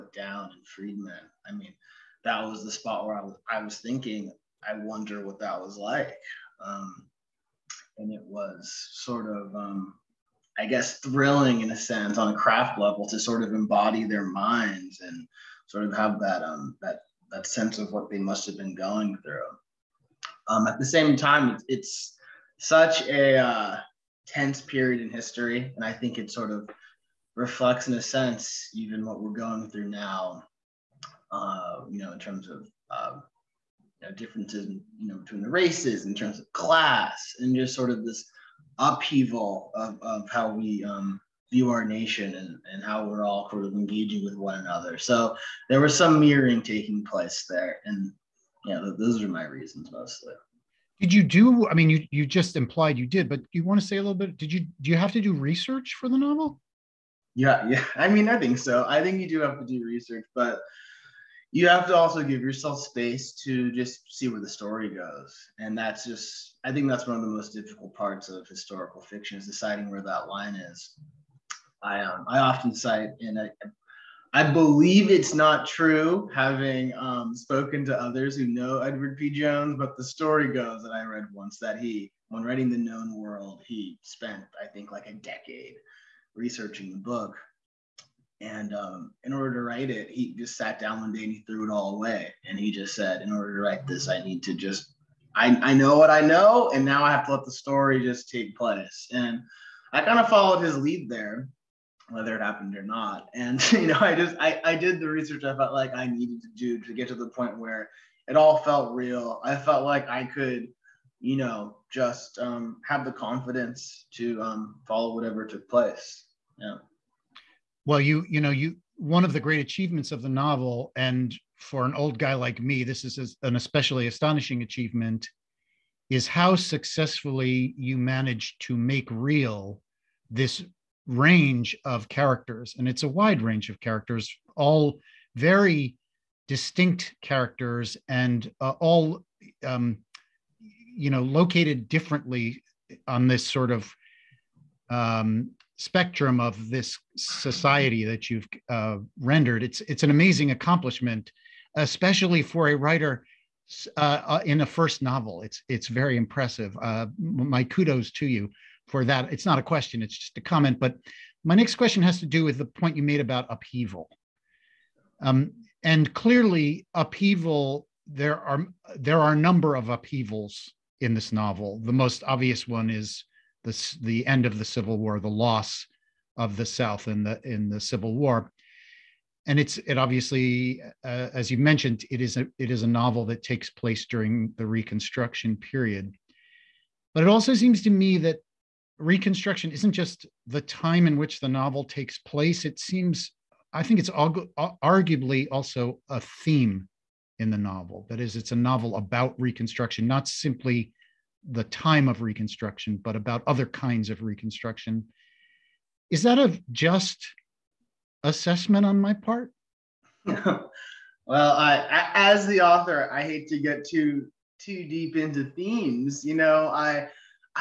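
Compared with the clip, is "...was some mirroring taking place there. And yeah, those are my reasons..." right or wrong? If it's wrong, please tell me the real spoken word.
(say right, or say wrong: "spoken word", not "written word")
right.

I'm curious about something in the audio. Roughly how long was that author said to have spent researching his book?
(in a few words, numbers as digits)
a decade.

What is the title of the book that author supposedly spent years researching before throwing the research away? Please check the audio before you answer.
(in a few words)
The Known World.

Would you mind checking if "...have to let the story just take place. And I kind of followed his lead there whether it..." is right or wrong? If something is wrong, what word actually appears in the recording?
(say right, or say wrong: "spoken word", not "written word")
right.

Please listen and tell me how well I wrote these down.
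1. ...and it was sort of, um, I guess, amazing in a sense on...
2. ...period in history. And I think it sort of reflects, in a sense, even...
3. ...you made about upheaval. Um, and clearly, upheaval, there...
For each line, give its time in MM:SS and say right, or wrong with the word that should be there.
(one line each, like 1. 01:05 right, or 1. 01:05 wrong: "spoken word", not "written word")
1. 00:07 wrong: "thrilling", not "amazing"
2. 00:24 right
3. 02:42 right.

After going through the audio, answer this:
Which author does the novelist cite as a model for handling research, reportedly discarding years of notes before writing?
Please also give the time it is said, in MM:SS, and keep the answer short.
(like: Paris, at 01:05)
Edward P. Jones, at 01:18.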